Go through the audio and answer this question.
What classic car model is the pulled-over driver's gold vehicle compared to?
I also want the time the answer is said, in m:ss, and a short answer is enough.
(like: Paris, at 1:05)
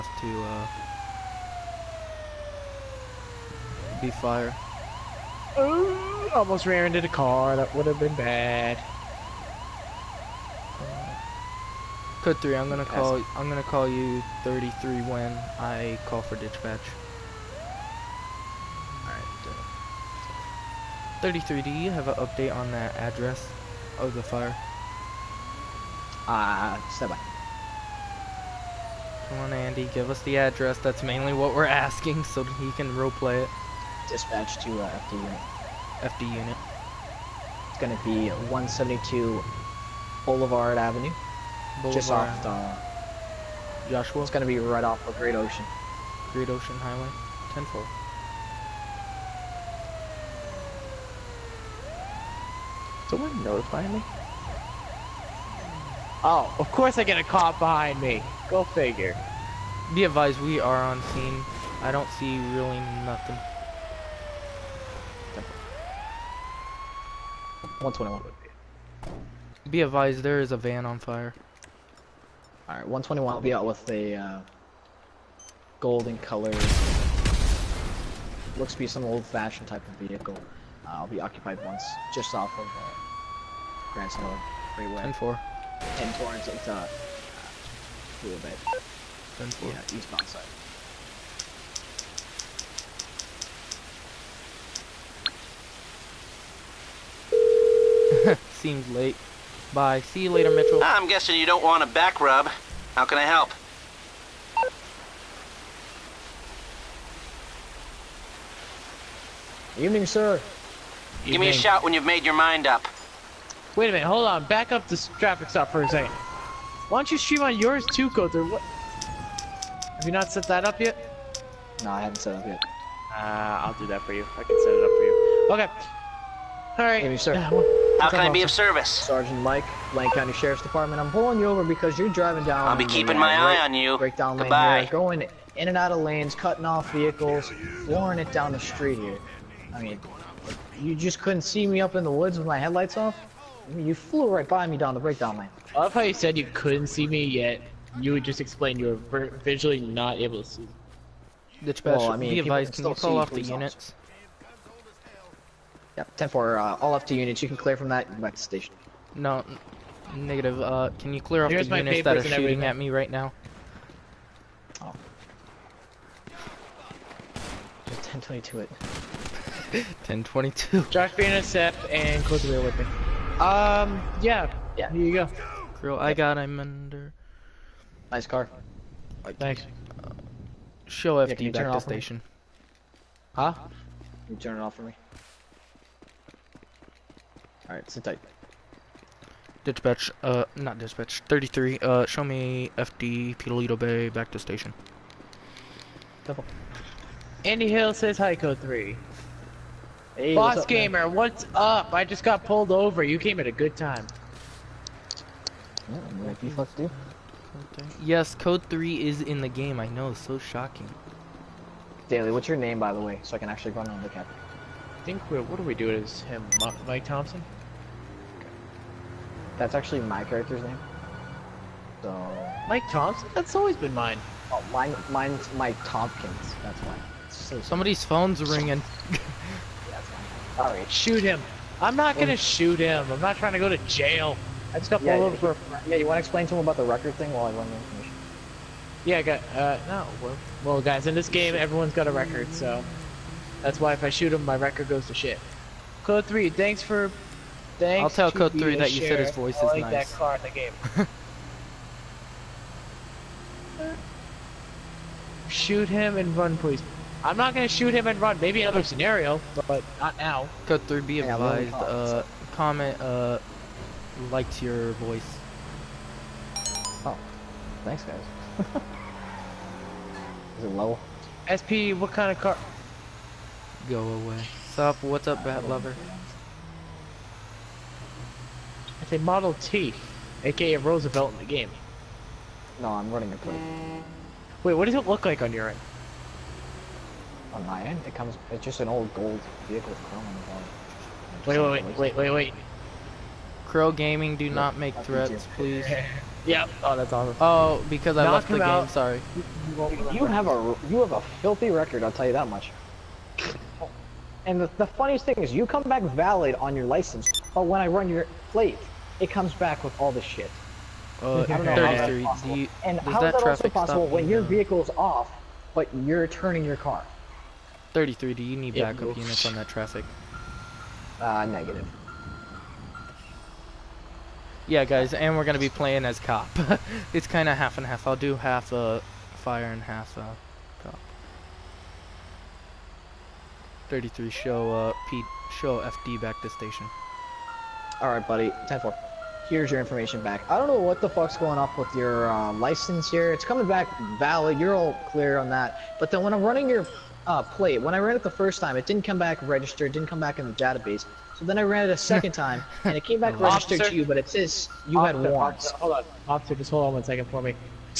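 Model T, at 4:39.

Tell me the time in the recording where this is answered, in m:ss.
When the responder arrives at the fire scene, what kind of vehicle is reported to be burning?
1:10.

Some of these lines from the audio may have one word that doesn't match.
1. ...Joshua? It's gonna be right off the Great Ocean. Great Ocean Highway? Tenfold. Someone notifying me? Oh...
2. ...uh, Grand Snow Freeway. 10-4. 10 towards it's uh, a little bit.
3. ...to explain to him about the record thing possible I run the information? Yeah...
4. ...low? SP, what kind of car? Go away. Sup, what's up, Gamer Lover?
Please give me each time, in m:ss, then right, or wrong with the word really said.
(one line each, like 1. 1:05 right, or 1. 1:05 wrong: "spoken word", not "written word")
1. 0:43 right
2. 1:22 right
3. 3:56 wrong: "while", not "possible"
4. 4:30 wrong: "Bat", not "Gamer".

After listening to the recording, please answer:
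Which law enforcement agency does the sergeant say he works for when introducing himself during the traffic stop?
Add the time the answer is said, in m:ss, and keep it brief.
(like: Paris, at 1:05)
Lane County Sheriff's Department, at 2:09.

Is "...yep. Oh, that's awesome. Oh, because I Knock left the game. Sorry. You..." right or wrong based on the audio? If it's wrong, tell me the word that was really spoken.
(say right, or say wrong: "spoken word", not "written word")
right.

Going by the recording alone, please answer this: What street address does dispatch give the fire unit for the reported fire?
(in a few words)
172 Boulevard Avenue.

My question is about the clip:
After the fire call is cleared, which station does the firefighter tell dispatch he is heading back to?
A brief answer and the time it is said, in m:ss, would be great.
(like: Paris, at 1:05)
Paleto Bay, at 3:13.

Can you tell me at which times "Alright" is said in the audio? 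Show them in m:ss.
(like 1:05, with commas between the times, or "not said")
1:12, 3:07, 5:38.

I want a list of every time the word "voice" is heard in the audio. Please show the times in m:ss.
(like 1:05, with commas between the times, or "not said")
4:09, 4:24.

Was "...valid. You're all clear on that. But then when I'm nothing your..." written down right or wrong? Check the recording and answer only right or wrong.
wrong.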